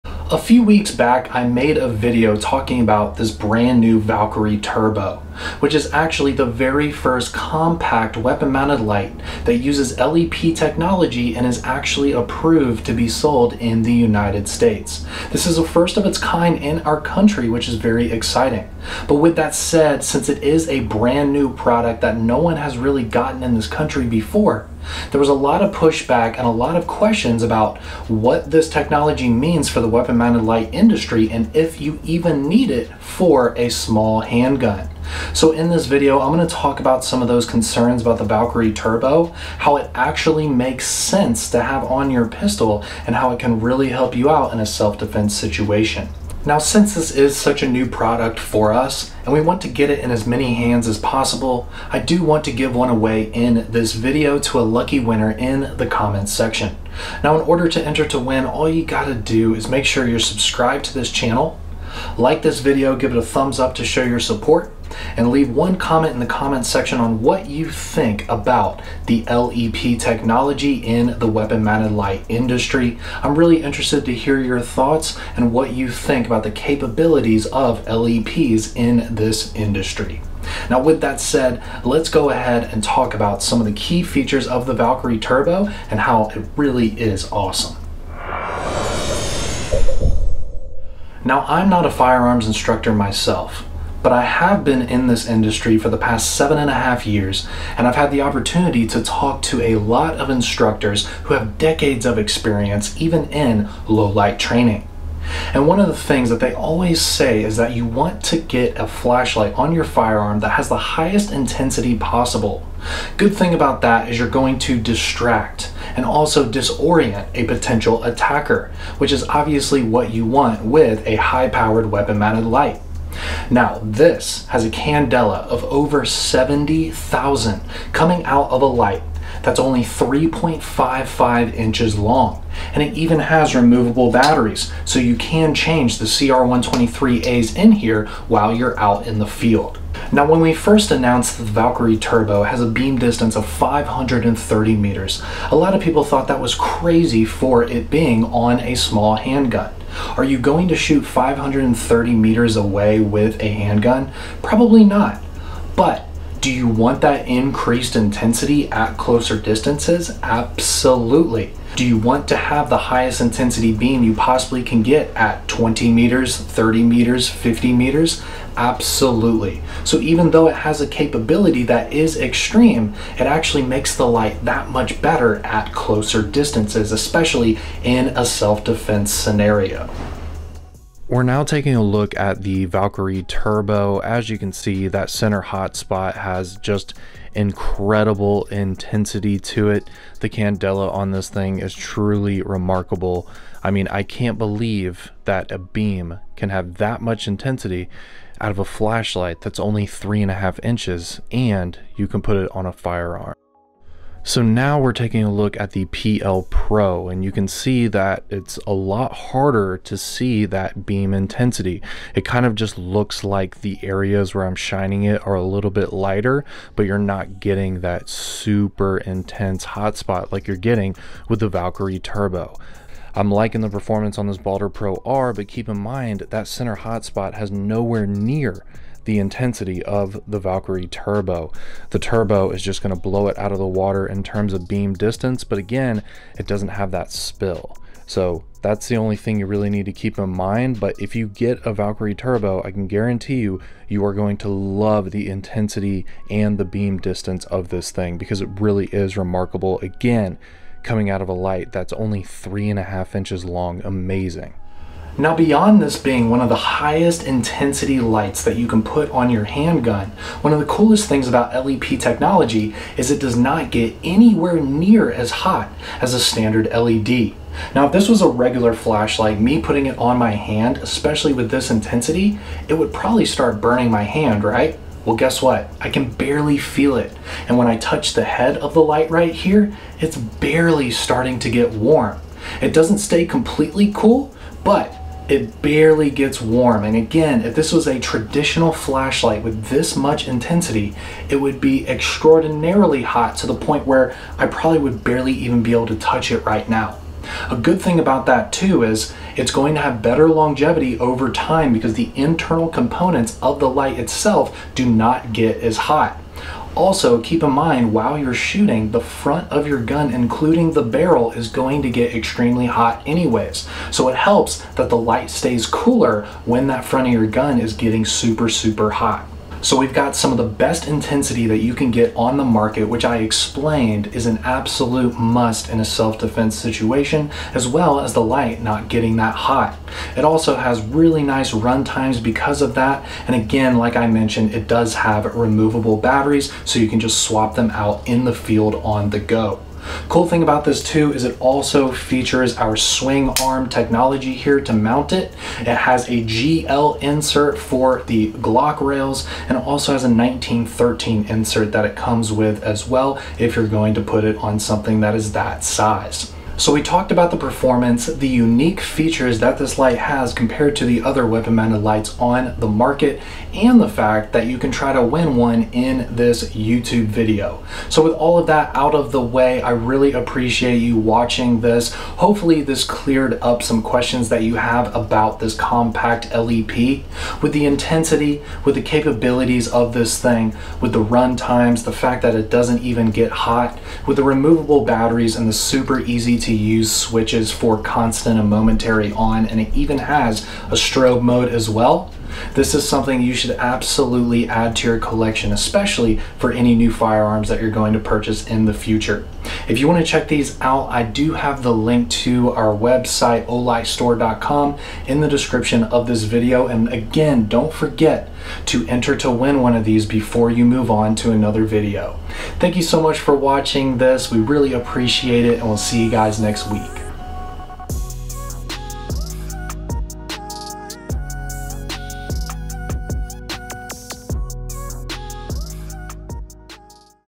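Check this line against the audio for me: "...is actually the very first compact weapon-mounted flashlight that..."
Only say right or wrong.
wrong.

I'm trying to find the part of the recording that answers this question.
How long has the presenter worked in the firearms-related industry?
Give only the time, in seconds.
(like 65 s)
96 s.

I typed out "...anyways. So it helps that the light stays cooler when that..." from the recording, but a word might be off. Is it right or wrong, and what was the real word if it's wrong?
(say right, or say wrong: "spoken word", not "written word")
right.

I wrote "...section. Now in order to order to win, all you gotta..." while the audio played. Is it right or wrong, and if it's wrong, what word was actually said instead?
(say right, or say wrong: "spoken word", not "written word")
wrong: "enter", not "order".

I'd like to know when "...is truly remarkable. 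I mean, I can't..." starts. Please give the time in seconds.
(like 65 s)
191 s.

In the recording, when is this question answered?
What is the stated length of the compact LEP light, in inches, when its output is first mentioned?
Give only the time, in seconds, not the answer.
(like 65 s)
129 s.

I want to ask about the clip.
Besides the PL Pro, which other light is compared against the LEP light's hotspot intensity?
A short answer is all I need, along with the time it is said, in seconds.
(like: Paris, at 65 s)
Baldr Pro R, at 224 s.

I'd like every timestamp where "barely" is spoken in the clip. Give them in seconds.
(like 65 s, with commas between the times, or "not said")
276 s, 280 s, 285 s, 295 s.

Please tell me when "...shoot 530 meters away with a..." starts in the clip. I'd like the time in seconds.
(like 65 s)
150 s.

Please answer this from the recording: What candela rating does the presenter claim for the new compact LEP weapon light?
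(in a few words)
over 70,000.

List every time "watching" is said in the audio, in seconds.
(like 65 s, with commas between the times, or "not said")
370 s, 413 s.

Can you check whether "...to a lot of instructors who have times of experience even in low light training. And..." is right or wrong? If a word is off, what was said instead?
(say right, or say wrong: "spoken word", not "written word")
wrong: "decades", not "times".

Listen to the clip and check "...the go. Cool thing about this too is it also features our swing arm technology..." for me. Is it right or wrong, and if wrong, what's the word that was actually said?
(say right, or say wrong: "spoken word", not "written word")
right.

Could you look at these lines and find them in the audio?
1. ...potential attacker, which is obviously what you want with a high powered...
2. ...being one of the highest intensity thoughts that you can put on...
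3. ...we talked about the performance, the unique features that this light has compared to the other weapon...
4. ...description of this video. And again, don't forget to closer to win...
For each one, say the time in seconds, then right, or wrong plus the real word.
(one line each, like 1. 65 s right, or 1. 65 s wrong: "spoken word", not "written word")
1. 117 s right
2. 255 s wrong: "lights", not "thoughts"
3. 356 s right
4. 405 s wrong: "enter", not "closer".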